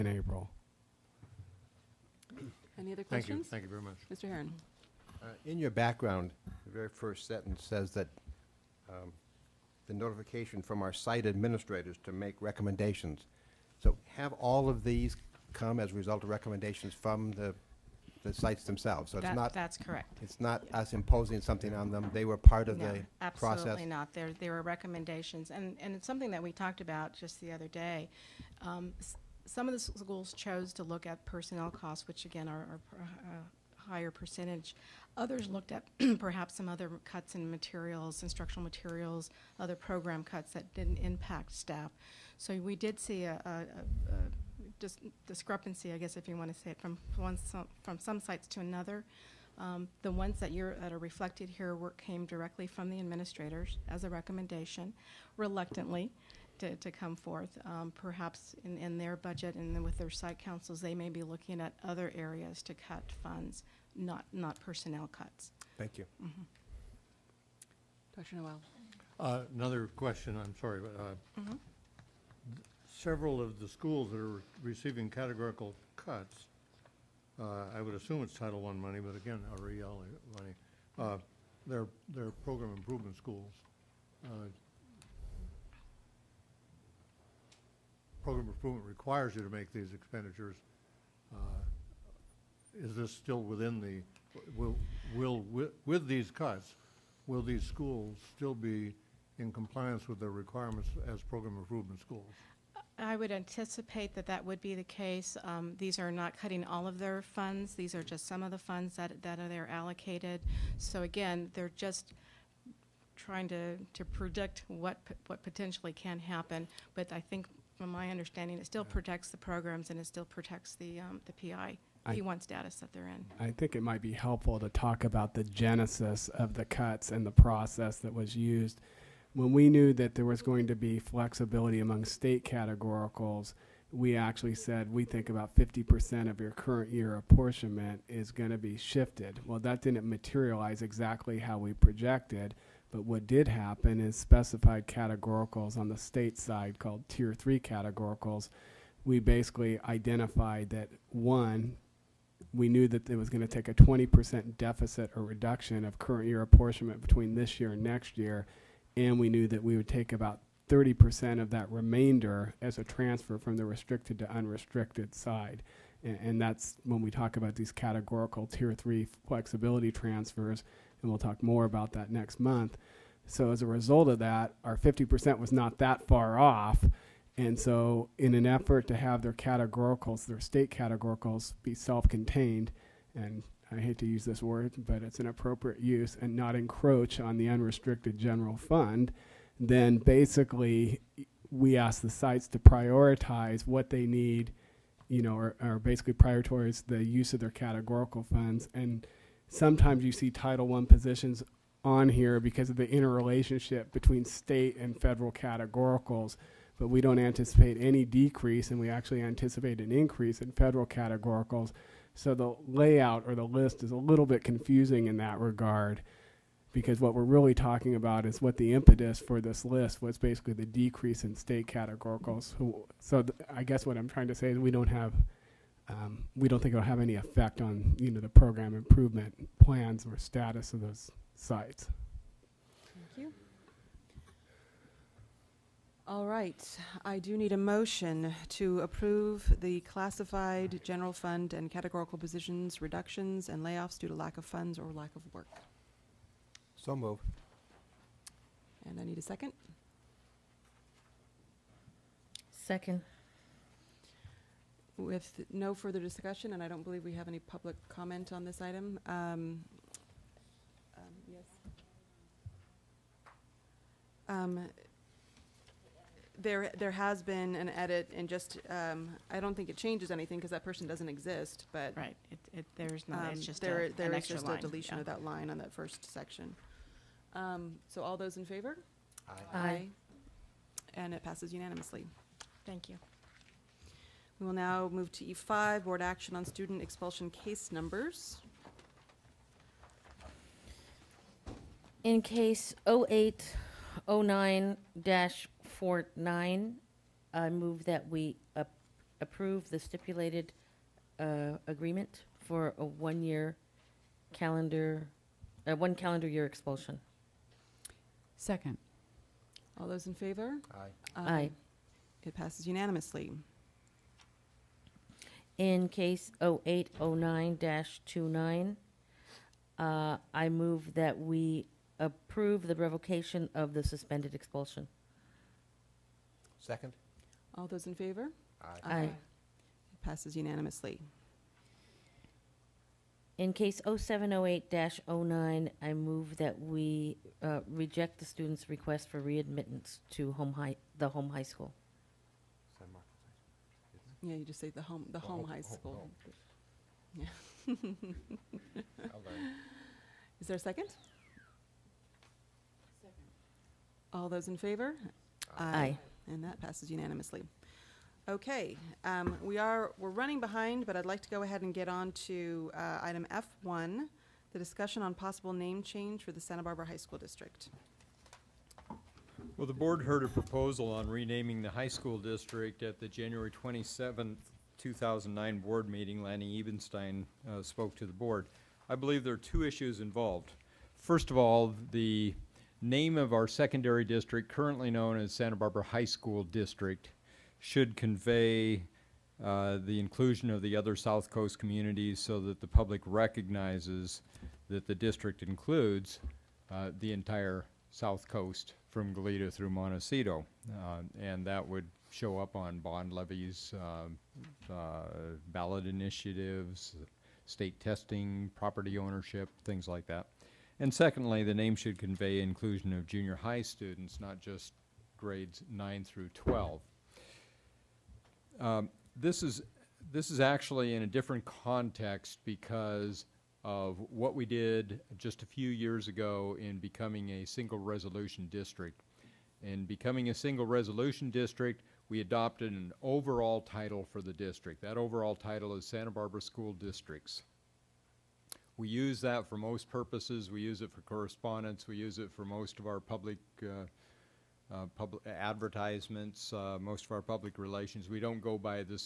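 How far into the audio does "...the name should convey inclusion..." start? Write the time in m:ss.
6:51.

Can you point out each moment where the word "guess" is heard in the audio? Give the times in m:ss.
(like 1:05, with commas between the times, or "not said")
0:45, 3:43.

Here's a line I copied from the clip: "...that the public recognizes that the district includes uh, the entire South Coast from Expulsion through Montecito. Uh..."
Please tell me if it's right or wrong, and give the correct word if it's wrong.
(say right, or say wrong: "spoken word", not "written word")
wrong: "Goleta", not "Expulsion".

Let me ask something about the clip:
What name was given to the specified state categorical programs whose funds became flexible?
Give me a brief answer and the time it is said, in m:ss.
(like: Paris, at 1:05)
tier three categoricals, at 2:27.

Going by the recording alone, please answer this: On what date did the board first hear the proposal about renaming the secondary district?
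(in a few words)
January 27, 2009.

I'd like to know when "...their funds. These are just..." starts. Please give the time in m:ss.
1:46.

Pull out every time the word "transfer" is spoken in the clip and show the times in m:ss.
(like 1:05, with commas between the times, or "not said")
2:42, 2:49.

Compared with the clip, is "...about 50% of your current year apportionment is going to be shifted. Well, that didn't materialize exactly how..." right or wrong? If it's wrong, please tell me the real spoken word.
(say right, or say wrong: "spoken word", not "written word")
right.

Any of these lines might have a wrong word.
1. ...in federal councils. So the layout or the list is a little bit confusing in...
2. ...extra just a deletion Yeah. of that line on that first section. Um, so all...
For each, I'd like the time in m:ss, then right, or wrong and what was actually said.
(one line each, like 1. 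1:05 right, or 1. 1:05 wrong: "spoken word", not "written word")
1. 3:30 wrong: "categoricals", not "councils"
2. 4:34 right.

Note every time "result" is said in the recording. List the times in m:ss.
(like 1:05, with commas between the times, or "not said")
0:15, 2:53.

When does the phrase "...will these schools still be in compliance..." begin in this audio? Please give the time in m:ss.
1:37.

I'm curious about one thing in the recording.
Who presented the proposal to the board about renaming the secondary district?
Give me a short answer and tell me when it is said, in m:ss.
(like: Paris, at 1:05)
Lanny Ebenstein, at 6:16.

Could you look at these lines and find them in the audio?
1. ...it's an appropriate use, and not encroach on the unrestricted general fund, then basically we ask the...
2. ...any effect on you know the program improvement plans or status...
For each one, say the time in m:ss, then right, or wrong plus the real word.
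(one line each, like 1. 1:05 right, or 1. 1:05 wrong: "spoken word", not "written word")
1. 3:05 right
2. 3:46 right.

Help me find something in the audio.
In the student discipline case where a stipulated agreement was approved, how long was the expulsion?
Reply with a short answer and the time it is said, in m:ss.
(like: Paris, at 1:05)
one calendar year, at 5:05.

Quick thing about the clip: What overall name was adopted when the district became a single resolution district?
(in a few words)
Santa Barbara School Districts.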